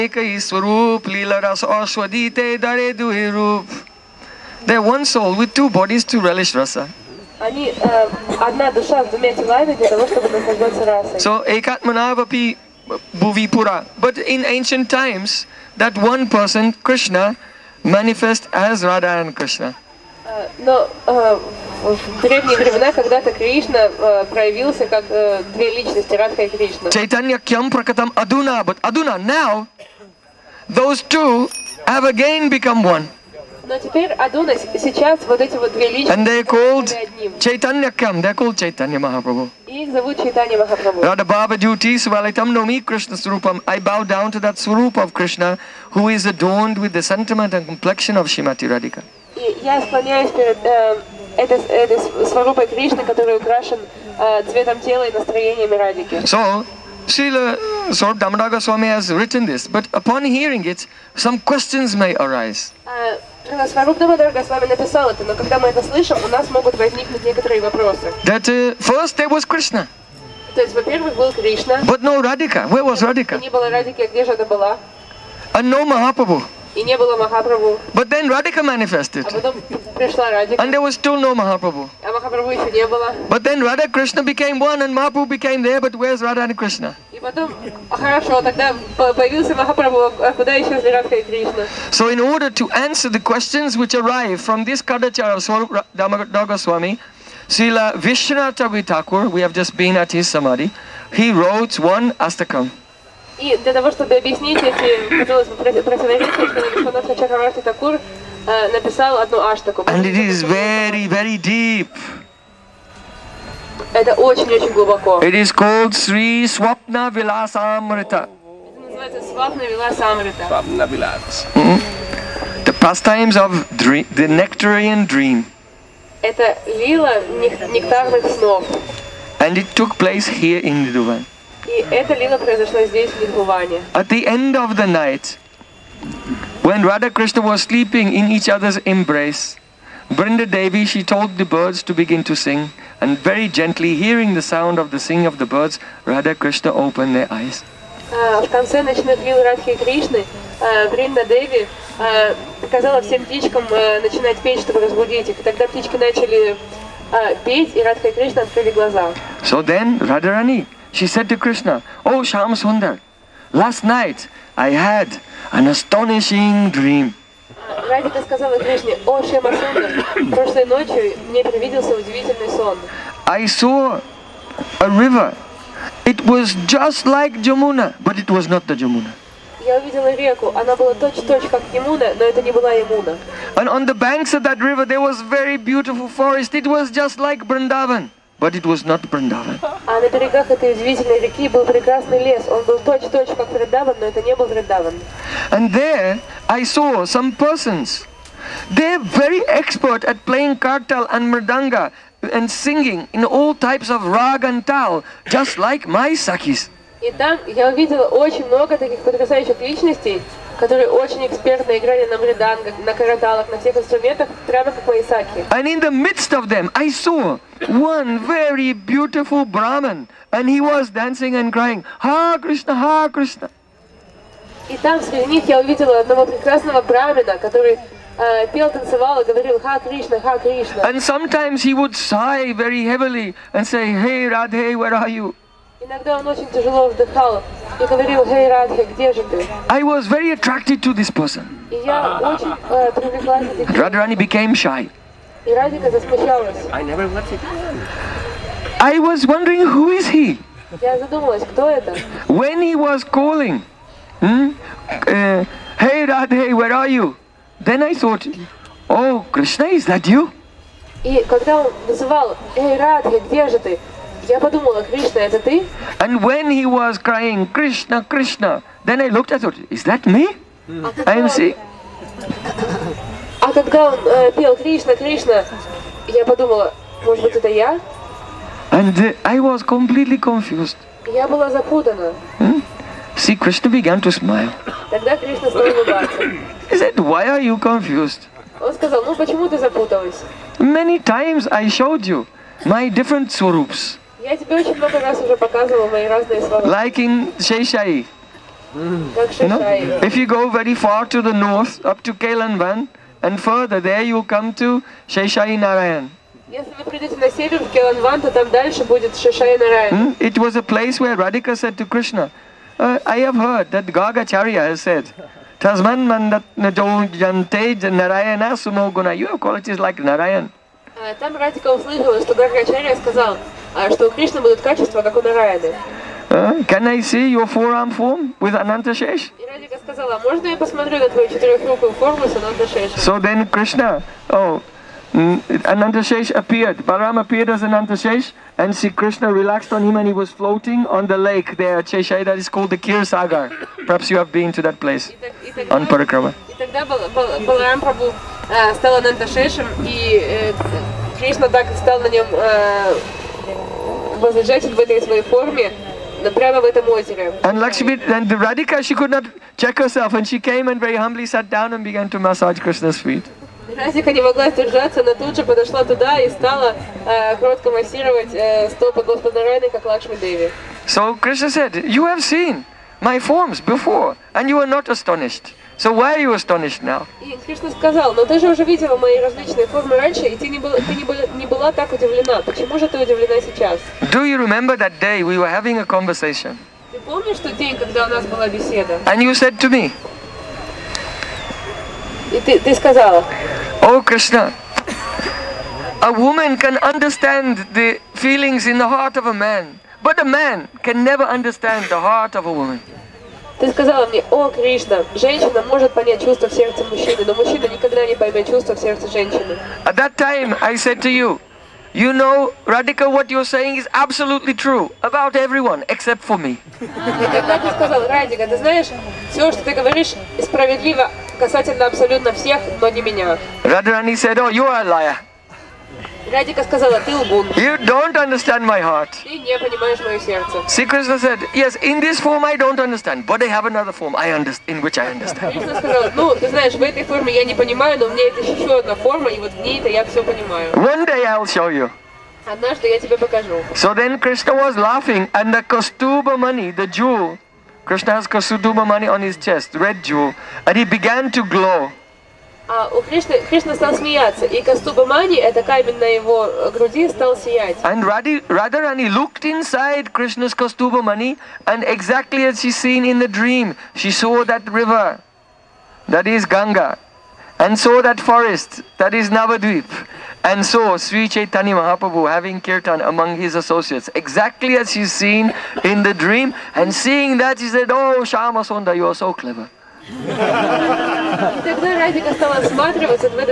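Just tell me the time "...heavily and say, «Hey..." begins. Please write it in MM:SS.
03:52.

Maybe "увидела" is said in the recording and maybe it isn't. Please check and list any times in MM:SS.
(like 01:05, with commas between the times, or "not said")
03:27, 03:45.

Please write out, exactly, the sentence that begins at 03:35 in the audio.
And in the midst of them, I saw one very beautiful Brahman, and he was dancing and crying, Ha Krishna, Ha Krishna.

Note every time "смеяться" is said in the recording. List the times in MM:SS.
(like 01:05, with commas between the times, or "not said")
07:33.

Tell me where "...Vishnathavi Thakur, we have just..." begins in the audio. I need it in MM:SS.
01:37.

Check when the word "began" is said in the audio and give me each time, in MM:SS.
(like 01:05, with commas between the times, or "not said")
04:43, 06:01, 07:30.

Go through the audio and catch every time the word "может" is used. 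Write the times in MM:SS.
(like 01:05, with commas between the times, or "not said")
04:37, 06:45.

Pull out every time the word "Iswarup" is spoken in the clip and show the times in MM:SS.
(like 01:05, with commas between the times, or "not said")
00:00.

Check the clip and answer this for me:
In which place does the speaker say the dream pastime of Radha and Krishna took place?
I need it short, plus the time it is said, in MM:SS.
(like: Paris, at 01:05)
Nidhuvan, at 02:10.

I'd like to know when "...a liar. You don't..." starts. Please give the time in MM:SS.
07:04.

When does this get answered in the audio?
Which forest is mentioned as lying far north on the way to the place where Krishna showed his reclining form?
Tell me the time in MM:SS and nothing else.
05:02.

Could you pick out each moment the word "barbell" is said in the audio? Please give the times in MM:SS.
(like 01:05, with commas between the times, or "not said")
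not said.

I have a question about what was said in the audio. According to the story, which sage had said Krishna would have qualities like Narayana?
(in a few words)
Gargacharya.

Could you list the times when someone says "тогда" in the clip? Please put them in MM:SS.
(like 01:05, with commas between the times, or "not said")
02:35, 04:44, 05:46, 08:01.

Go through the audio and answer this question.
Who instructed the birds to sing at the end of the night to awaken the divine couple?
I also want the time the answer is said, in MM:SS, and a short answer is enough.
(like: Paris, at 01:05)
Brinda Devi, at 02:20.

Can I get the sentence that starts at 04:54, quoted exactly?
Я тебе очень много раз уже показывала мои разные слова.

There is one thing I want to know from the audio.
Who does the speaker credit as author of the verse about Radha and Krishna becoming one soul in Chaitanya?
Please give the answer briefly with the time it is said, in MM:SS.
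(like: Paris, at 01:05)
Srila Swarup Damodar Swami, at 00:57.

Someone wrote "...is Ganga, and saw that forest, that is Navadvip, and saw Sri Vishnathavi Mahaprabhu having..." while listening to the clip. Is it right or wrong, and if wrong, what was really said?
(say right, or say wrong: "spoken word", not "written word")
wrong: "Chaitanya", not "Vishnathavi".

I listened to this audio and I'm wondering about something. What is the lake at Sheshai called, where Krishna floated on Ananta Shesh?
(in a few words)
Kirsagar.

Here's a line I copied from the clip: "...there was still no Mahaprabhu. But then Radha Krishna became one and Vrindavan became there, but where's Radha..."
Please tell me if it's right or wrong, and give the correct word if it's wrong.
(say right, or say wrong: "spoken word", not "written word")
wrong: "Mahaprabhu", not "Vrindavan".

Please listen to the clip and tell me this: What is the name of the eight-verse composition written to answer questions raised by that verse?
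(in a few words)
Sri Swapna Vilasamrita.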